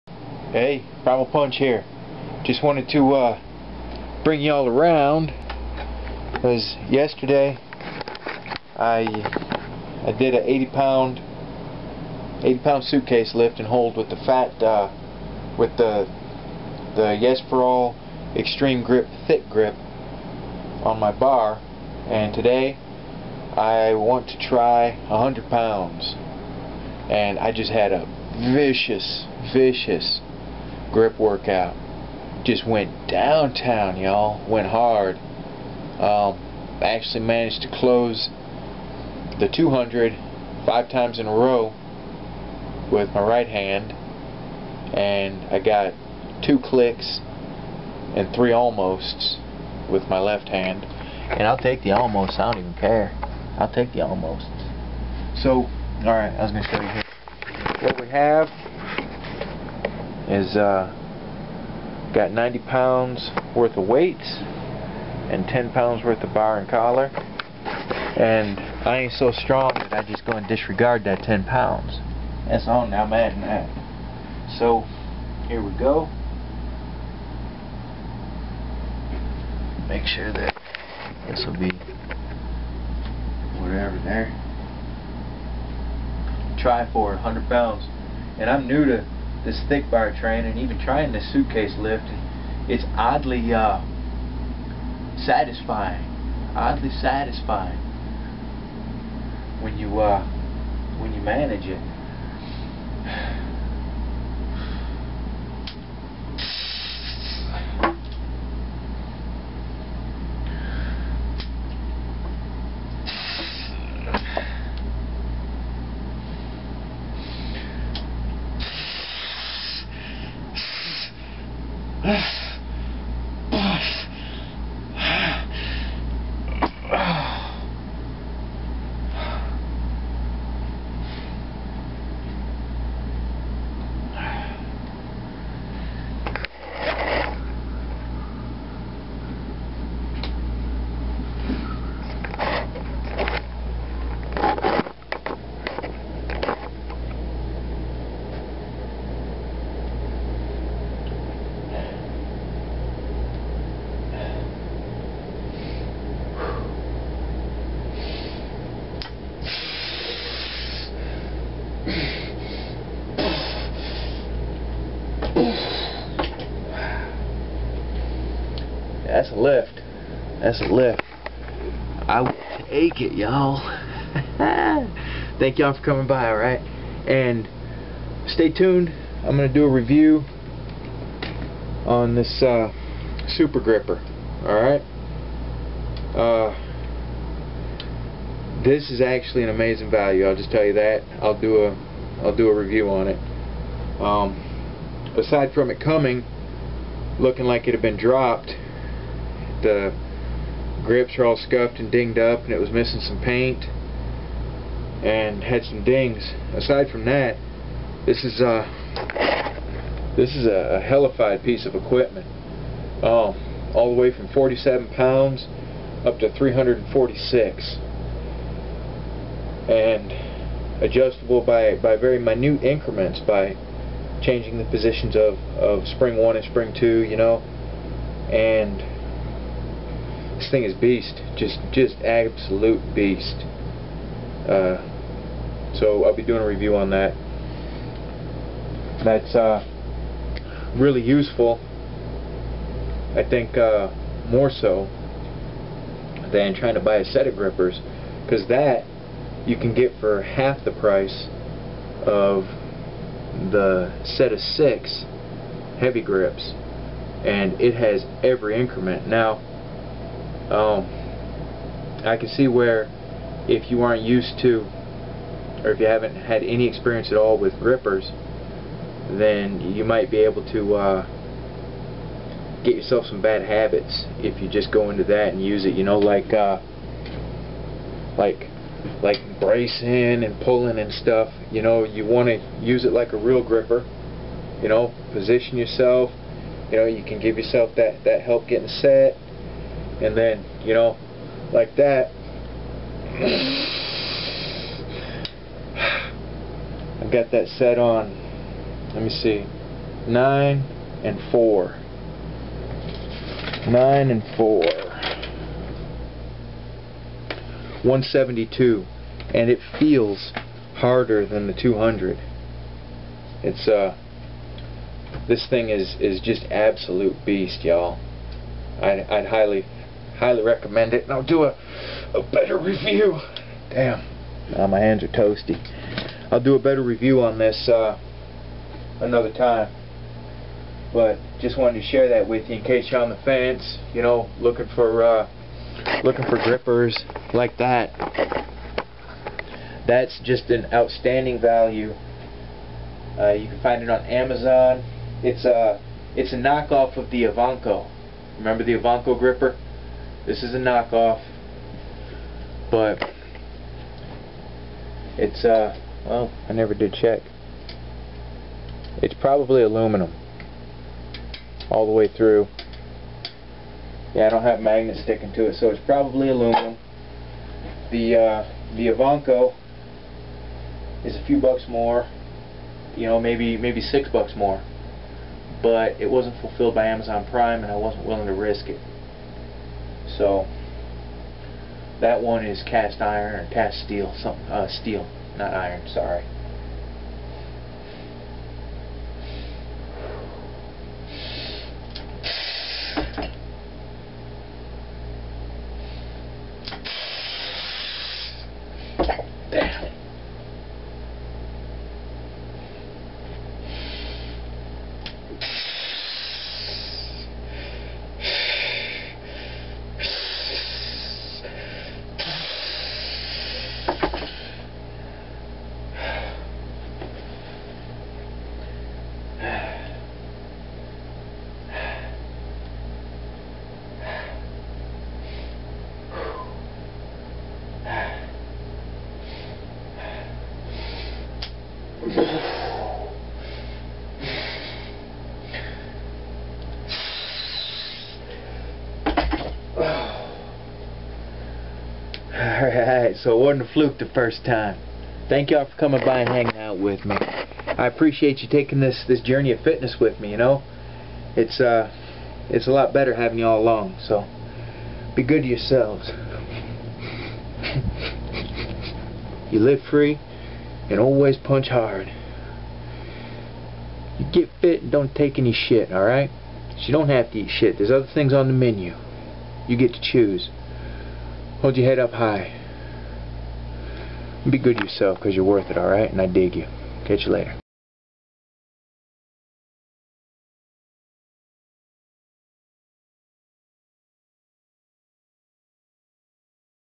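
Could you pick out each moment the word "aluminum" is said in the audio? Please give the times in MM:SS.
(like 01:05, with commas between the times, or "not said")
05:59, 06:06.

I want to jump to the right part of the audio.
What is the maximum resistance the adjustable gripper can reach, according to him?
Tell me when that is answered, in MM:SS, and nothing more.
03:36.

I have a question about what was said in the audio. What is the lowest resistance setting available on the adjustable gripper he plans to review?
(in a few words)
47 pounds.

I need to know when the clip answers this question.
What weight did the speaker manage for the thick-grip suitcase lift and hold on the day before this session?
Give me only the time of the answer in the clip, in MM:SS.
00:12.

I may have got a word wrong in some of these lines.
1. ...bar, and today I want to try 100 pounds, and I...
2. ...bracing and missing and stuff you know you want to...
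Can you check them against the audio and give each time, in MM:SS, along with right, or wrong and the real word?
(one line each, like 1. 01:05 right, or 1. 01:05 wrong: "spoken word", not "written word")
1. 00:21 right
2. 04:39 wrong: "pulling", not "missing".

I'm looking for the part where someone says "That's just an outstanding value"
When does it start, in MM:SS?
05:39.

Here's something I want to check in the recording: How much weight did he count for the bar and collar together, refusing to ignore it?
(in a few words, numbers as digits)
10 pounds.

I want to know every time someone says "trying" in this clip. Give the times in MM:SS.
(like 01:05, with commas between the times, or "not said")
01:30, 04:06.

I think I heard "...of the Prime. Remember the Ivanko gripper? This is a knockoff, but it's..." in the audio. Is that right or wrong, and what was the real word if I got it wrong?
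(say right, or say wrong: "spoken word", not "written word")
wrong: "Ivanko", not "Prime".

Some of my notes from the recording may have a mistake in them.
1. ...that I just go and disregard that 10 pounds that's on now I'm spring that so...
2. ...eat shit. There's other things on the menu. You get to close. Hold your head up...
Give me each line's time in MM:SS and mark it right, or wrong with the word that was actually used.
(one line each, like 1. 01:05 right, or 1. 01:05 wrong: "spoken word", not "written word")
1. 01:09 wrong: "adding", not "spring"
2. 07:47 wrong: "choose", not "close".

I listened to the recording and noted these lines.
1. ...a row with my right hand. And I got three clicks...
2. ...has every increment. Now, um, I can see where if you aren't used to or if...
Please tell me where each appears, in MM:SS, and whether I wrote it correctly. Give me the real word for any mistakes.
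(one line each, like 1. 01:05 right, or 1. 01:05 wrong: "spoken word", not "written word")
1. 00:41 wrong: "two", not "three"
2. 04:17 right.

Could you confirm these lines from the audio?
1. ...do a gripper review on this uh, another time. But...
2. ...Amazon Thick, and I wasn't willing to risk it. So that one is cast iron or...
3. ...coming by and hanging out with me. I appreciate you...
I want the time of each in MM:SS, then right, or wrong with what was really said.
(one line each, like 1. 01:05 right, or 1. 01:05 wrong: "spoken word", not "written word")
1. 05:26 wrong: "better", not "gripper"
2. 06:16 wrong: "Prime", not "Thick"
3. 07:25 right.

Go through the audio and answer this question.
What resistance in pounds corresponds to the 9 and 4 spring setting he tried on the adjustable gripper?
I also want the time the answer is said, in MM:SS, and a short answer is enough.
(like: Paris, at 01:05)
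172, at 05:07.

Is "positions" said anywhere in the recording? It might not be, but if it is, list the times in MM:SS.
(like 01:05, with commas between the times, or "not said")
03:44, 04:45.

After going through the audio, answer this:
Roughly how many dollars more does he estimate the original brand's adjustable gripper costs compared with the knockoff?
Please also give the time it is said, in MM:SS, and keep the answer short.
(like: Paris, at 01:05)
6 dollars, at 06:13.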